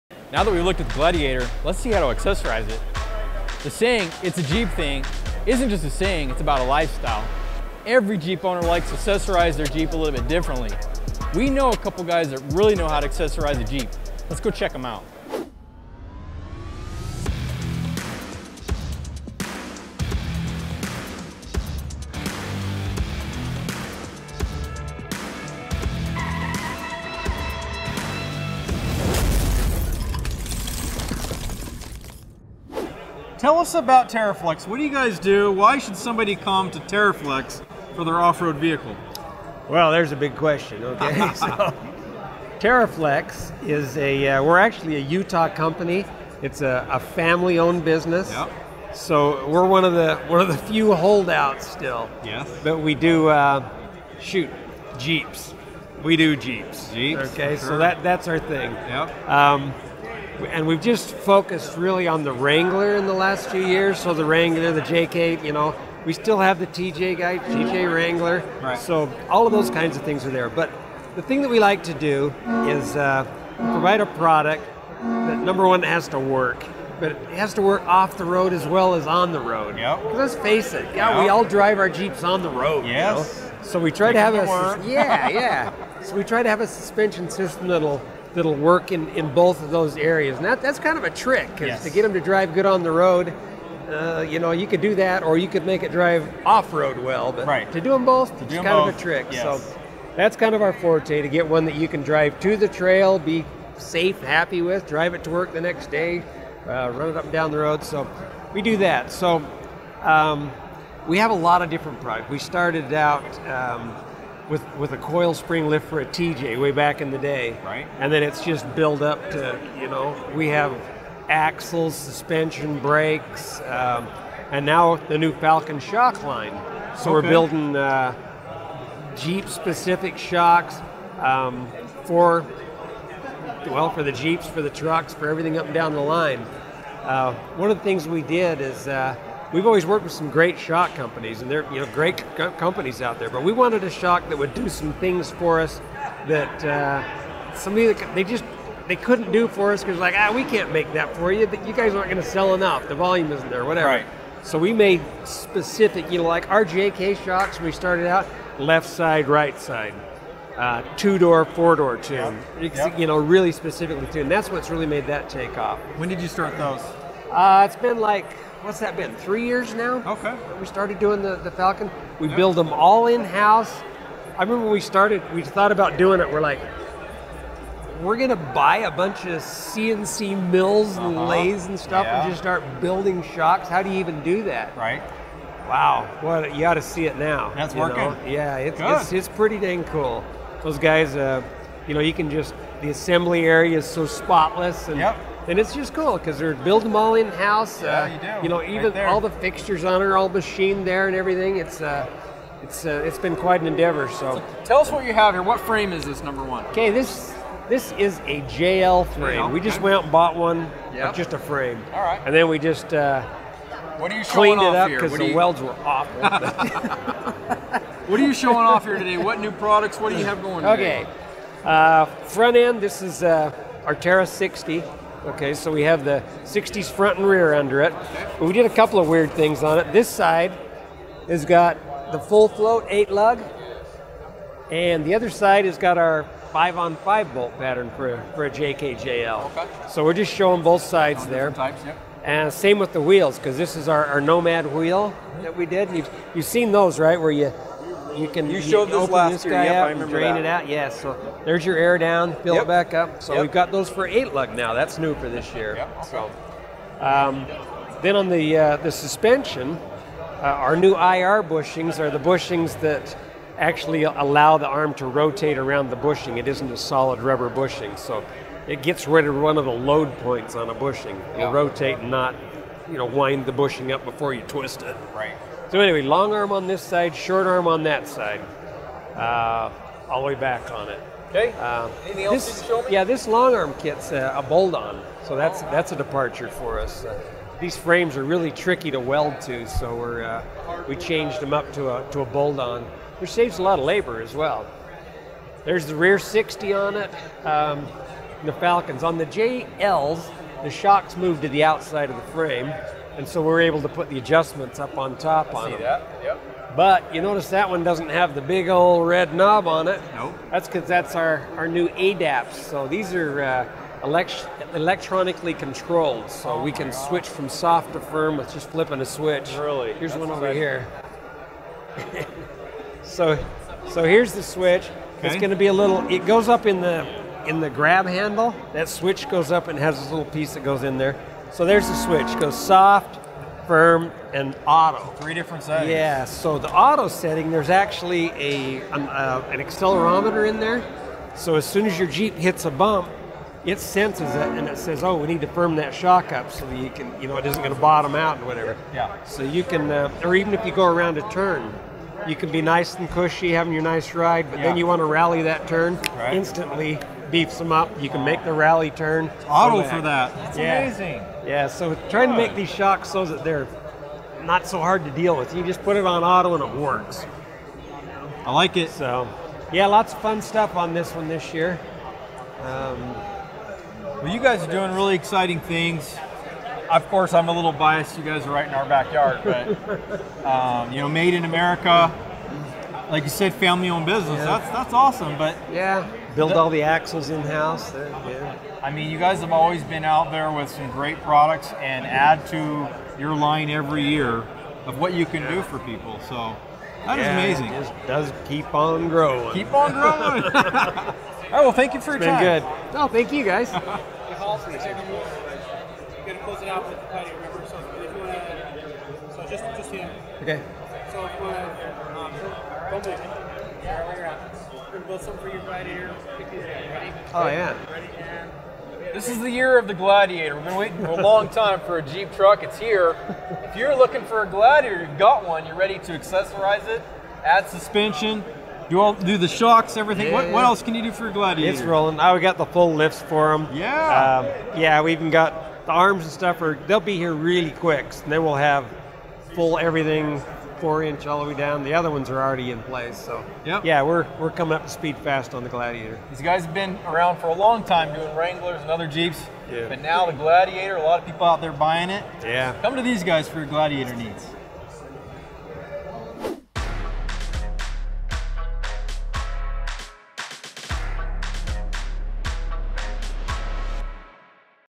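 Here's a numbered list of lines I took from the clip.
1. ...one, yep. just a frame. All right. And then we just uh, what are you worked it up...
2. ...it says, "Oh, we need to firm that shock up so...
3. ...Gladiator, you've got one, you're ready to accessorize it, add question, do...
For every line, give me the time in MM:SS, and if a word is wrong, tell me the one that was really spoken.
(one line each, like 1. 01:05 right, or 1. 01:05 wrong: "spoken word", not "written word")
1. 03:30 wrong: "cleaned", not "worked"
2. 05:44 right
3. 07:04 wrong: "suspension", not "question".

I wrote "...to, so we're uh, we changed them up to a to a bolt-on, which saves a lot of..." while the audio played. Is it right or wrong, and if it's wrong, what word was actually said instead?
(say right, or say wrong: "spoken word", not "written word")
right.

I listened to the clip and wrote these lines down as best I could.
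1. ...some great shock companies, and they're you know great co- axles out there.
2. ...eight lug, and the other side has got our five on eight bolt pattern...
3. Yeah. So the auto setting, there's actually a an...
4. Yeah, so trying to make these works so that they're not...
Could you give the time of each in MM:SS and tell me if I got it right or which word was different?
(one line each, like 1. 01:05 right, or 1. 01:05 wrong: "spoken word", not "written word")
1. 02:20 wrong: "companies", not "axles"
2. 03:52 wrong: "five", not "eight"
3. 05:35 right
4. 06:01 wrong: "shocks", not "works".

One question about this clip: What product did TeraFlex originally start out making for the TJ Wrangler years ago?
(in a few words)
coil spring lift.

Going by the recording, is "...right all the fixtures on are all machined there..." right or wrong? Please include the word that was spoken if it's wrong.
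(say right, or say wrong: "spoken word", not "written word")
right.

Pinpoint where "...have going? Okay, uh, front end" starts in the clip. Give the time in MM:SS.
03:40.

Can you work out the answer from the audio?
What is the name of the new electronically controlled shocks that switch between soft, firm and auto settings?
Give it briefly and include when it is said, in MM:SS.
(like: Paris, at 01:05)
ADAPs, at 05:11.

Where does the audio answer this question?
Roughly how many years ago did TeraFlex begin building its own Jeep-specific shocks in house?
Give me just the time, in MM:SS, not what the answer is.
02:49.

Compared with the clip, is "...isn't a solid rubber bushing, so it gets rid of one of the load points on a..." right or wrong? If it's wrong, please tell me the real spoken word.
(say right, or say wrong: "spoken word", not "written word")
right.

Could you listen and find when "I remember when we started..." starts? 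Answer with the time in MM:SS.
02:54.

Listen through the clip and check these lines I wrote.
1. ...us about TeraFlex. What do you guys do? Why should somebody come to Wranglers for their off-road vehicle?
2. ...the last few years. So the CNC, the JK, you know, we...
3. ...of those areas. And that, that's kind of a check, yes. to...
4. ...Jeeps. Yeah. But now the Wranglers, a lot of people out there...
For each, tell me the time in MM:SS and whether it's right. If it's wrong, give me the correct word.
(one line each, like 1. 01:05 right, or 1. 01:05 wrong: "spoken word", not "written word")
1. 00:33 wrong: "TeraFlex", not "Wranglers"
2. 01:03 wrong: "Wrangler", not "CNC"
3. 01:29 wrong: "trick", not "check"
4. 07:29 wrong: "Gladiator", not "Wranglers".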